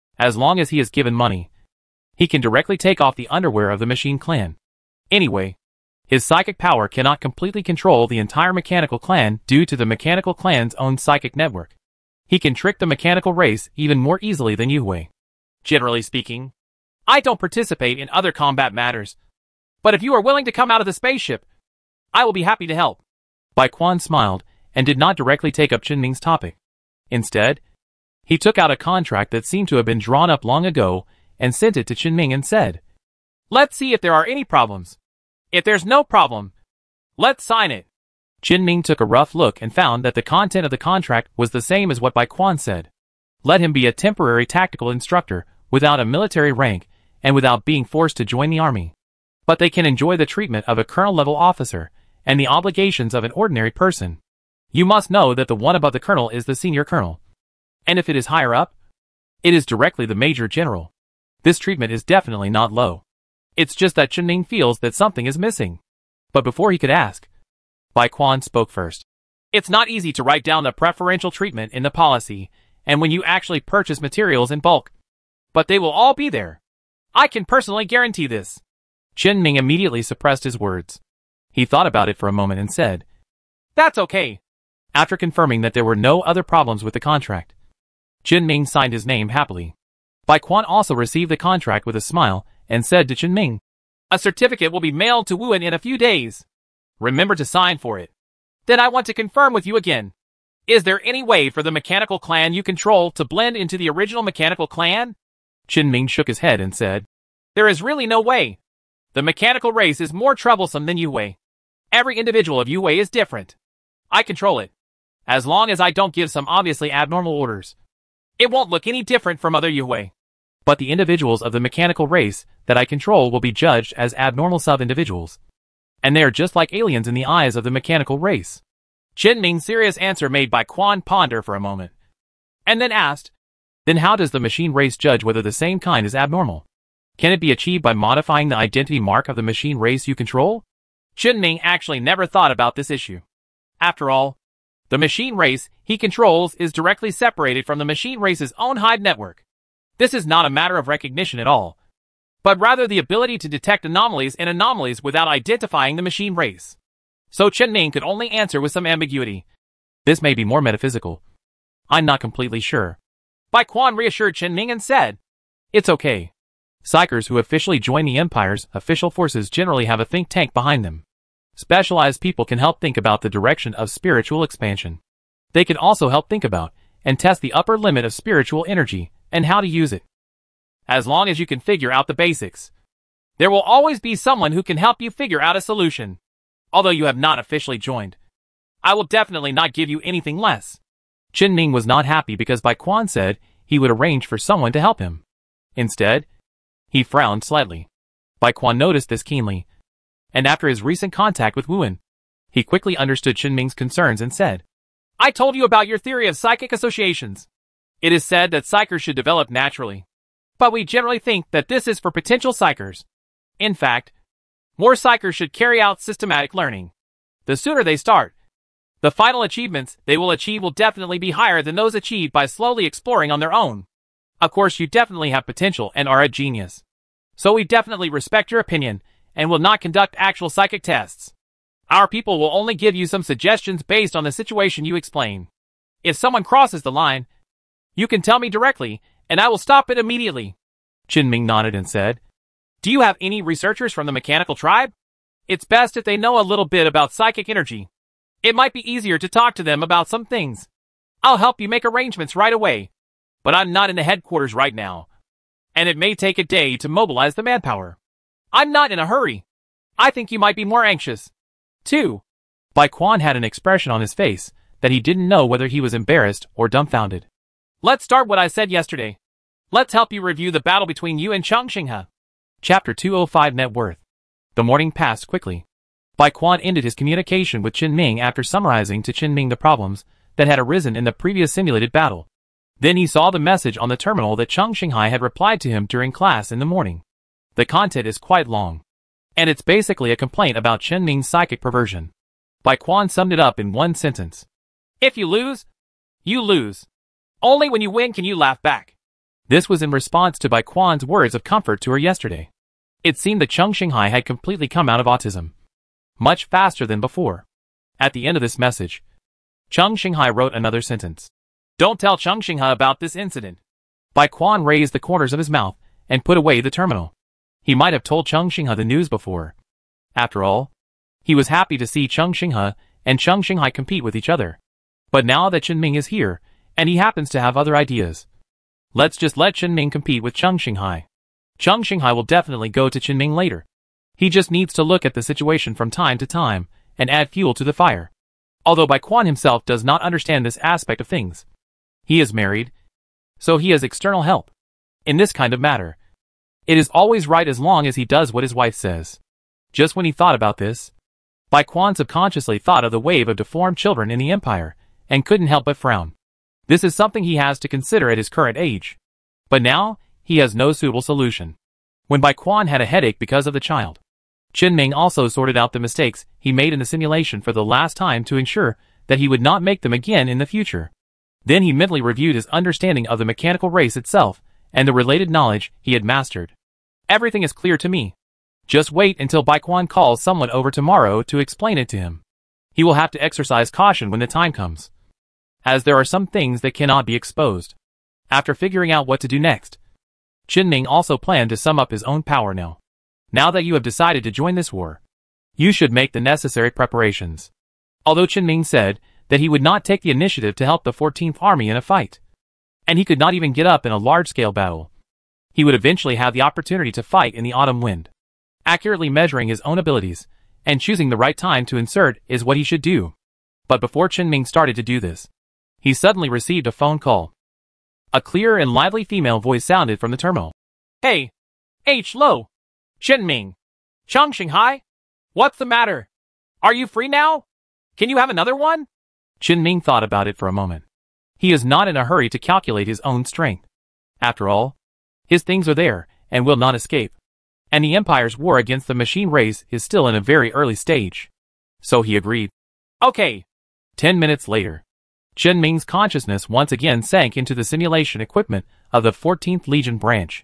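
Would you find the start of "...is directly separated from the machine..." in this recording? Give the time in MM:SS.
02:26.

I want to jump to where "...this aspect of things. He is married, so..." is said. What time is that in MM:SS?
05:40.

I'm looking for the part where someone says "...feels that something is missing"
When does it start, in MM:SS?
01:04.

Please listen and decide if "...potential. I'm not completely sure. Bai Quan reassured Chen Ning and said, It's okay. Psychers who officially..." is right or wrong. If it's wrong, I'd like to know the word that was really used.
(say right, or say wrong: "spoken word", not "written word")
wrong: "metaphysical", not "potential".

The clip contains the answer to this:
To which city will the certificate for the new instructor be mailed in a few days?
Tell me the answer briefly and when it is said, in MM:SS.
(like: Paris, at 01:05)
Wuhan, at 01:35.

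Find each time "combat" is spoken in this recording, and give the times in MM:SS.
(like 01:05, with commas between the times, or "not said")
00:18.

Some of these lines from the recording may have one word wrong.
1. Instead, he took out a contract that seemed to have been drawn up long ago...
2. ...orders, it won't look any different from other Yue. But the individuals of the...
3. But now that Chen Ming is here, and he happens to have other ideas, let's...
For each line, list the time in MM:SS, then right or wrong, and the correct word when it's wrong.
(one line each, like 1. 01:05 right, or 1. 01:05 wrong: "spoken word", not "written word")
1. 00:27 right
2. 01:57 right
3. 05:25 right.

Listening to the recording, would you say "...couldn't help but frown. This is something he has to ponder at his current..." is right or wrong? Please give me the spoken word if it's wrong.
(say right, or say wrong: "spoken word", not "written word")
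wrong: "consider", not "ponder".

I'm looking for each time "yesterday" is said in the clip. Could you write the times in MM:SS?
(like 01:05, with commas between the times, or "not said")
04:28, 05:01.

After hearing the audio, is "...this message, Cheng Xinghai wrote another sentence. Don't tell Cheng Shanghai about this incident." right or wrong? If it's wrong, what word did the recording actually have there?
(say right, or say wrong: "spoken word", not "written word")
right.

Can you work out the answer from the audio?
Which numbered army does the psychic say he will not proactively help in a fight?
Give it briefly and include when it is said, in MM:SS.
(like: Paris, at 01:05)
14th Army, at 06:40.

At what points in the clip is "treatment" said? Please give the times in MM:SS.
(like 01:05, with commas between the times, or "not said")
00:50, 01:01, 01:11.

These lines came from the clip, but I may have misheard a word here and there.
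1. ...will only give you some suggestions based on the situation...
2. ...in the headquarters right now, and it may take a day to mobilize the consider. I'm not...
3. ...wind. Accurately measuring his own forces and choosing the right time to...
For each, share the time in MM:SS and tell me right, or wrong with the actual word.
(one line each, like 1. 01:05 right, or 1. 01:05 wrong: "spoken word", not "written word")
1. 03:52 right
2. 04:13 wrong: "manpower", not "consider"
3. 06:47 wrong: "abilities", not "forces".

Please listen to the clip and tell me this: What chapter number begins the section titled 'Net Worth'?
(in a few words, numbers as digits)
205.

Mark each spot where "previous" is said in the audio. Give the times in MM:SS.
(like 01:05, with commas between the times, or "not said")
04:41.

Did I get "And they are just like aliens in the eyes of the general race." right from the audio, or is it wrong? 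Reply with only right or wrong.
wrong.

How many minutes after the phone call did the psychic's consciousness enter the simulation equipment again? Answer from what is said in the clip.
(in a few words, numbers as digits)
10.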